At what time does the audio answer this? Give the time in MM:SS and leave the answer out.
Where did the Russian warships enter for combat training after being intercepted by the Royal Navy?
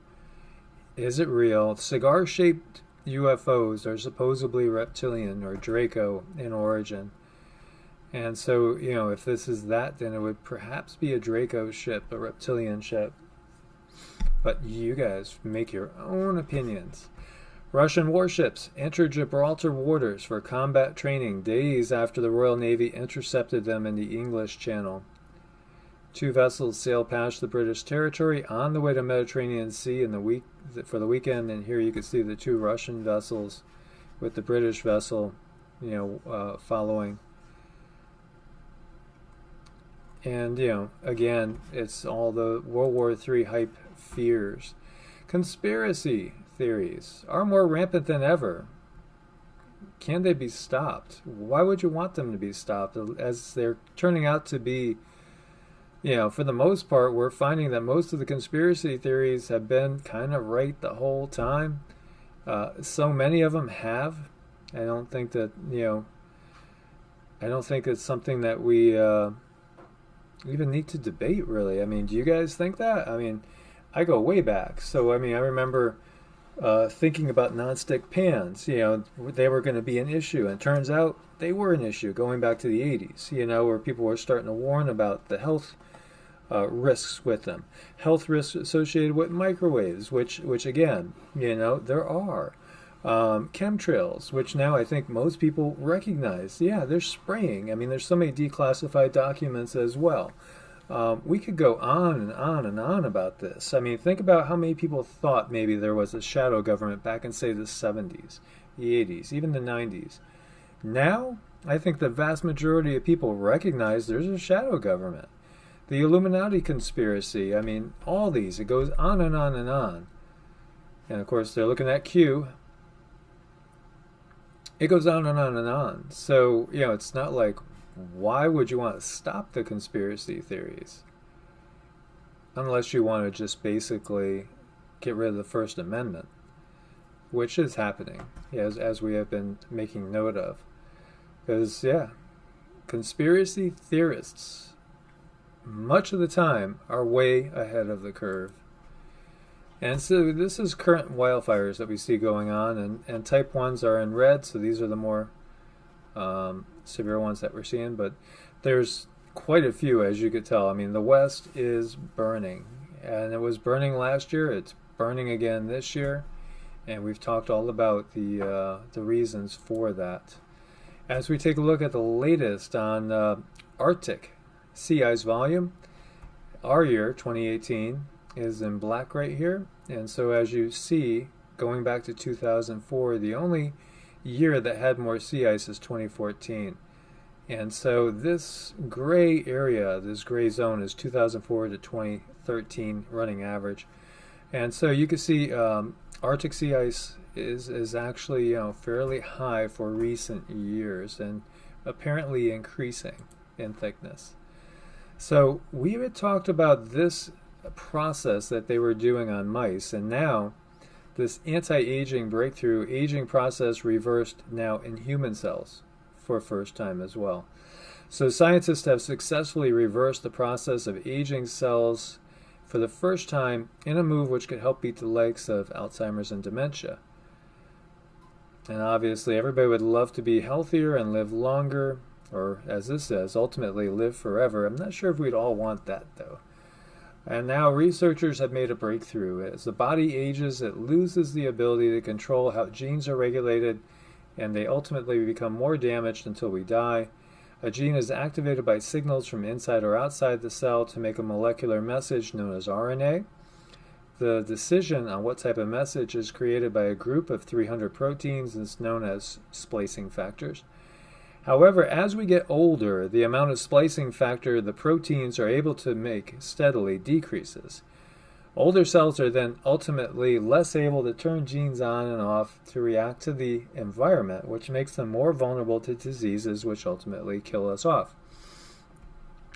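00:19.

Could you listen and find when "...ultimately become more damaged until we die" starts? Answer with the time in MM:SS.
04:04.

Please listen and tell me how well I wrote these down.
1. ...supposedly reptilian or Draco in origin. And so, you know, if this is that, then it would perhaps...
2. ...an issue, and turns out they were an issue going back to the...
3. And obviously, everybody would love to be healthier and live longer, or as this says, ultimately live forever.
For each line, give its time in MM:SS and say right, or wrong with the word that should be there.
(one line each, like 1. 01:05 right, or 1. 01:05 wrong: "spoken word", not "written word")
1. 00:03 right
2. 01:19 right
3. 03:48 right.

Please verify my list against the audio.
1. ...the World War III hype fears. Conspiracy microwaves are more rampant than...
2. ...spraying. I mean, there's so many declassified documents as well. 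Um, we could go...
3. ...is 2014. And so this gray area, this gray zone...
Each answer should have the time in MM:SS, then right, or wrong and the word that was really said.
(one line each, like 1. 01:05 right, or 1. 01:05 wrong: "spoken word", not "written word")
1. 00:42 wrong: "theories", not "microwaves"
2. 01:37 right
3. 03:05 right.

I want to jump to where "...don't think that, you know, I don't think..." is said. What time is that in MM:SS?
01:04.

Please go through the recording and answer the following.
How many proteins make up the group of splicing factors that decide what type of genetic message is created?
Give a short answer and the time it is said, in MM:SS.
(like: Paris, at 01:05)
300, at 04:17.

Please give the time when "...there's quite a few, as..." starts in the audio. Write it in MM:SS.
02:38.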